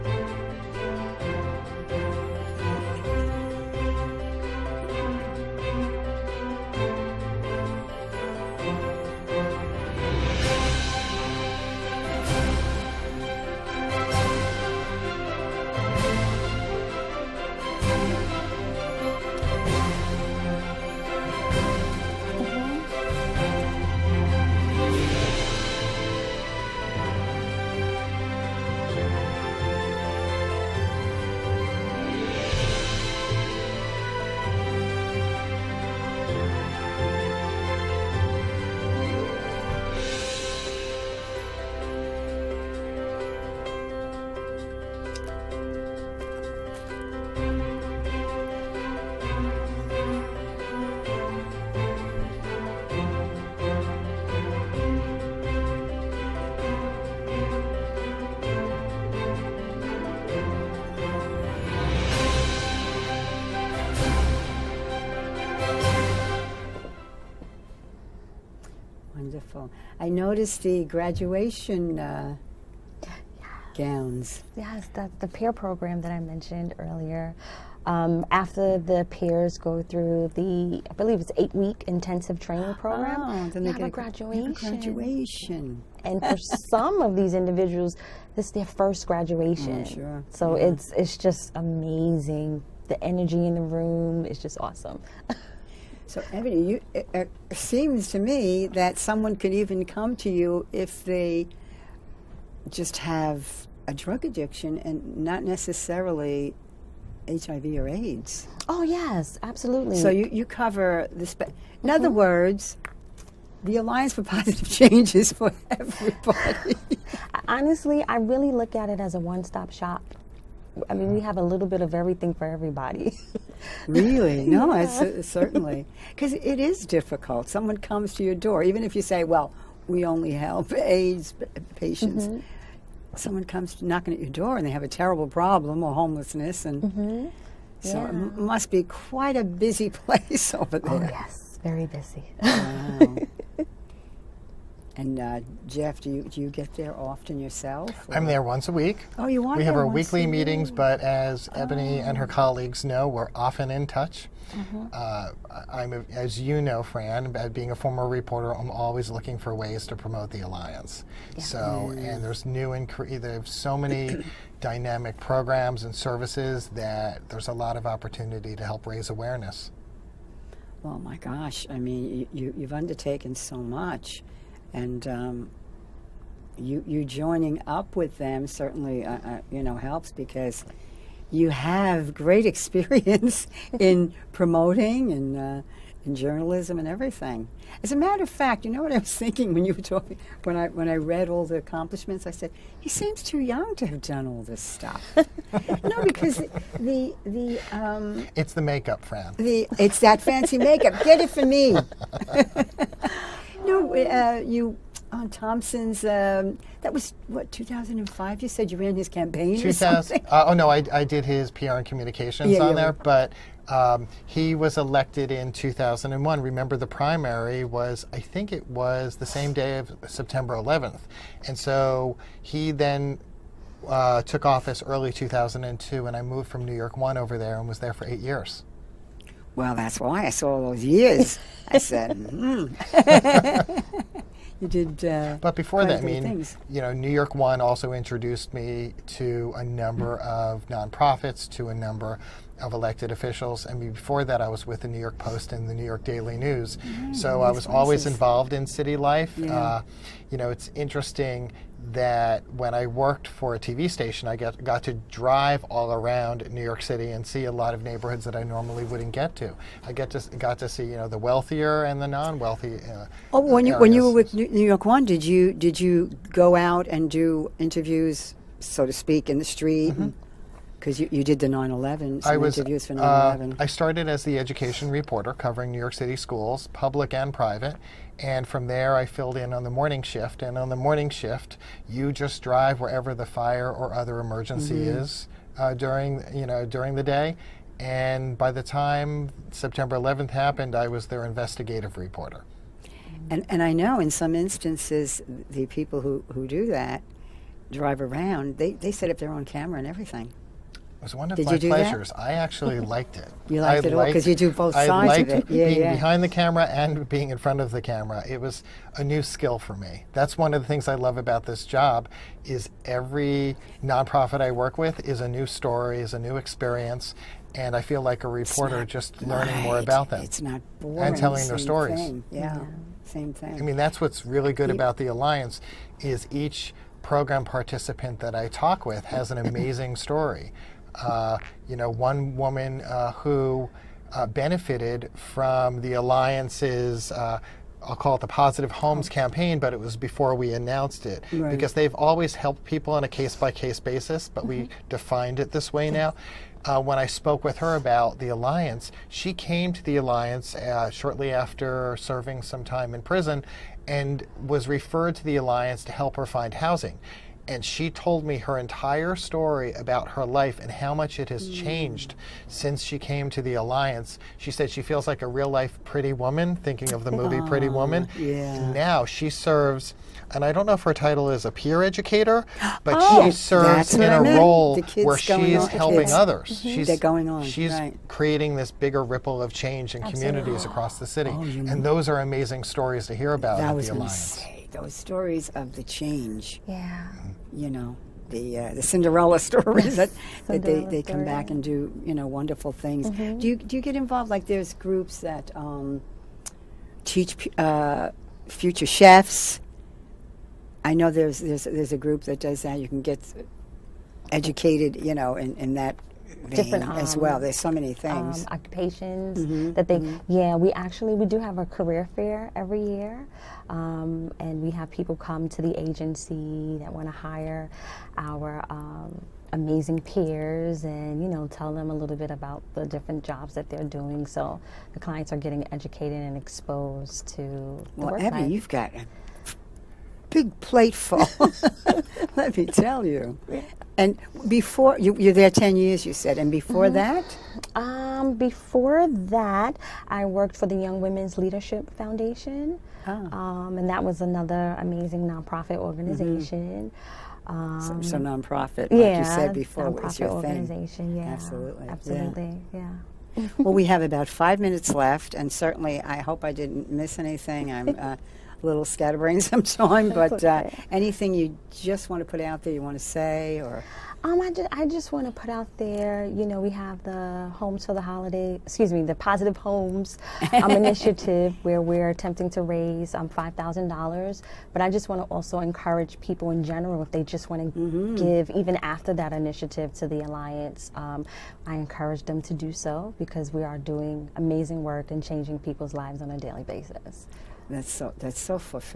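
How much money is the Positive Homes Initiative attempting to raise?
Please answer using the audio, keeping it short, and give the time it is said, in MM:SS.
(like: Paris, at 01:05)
$5,000, at 07:53.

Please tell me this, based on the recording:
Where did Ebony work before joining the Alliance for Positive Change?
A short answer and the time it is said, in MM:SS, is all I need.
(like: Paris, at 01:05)
Young Women's Leadership Foundation, at 07:20.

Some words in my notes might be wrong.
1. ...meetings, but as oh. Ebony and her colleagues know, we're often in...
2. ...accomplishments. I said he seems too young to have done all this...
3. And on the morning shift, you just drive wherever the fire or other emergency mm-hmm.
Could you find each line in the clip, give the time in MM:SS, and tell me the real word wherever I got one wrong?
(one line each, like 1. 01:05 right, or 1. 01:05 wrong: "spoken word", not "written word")
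1. 02:30 right
2. 03:11 right
3. 04:40 right.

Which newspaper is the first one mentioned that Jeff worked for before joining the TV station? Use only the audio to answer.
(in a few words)
New York Post.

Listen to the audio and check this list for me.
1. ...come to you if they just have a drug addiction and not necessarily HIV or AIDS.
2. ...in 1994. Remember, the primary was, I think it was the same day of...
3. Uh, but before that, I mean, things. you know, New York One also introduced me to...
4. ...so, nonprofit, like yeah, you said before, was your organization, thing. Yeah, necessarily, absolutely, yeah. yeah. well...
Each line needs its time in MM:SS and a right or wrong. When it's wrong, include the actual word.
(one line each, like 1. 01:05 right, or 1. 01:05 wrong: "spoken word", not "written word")
1. 01:39 right
2. 03:35 wrong: "2001", not "1994"
3. 03:55 right
4. 07:28 wrong: "absolutely", not "necessarily".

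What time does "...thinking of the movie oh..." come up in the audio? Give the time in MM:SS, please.
06:06.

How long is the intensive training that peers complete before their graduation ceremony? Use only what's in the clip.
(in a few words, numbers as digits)
8 weeks.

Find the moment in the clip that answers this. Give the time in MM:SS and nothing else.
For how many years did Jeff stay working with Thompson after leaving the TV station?
03:48.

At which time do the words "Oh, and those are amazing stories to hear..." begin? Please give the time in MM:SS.
06:21.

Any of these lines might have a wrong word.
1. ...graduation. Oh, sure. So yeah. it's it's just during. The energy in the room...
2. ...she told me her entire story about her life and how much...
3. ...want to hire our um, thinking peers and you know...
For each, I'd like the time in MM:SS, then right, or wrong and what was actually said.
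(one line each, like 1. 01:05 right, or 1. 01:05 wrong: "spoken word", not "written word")
1. 01:29 wrong: "amazing", not "during"
2. 05:57 right
3. 06:56 wrong: "amazing", not "thinking".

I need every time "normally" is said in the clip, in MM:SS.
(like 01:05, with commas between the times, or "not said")
04:18.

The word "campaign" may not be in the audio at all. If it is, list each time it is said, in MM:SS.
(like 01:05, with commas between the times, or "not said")
03:29, 05:39.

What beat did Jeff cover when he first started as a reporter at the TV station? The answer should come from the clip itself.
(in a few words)
education.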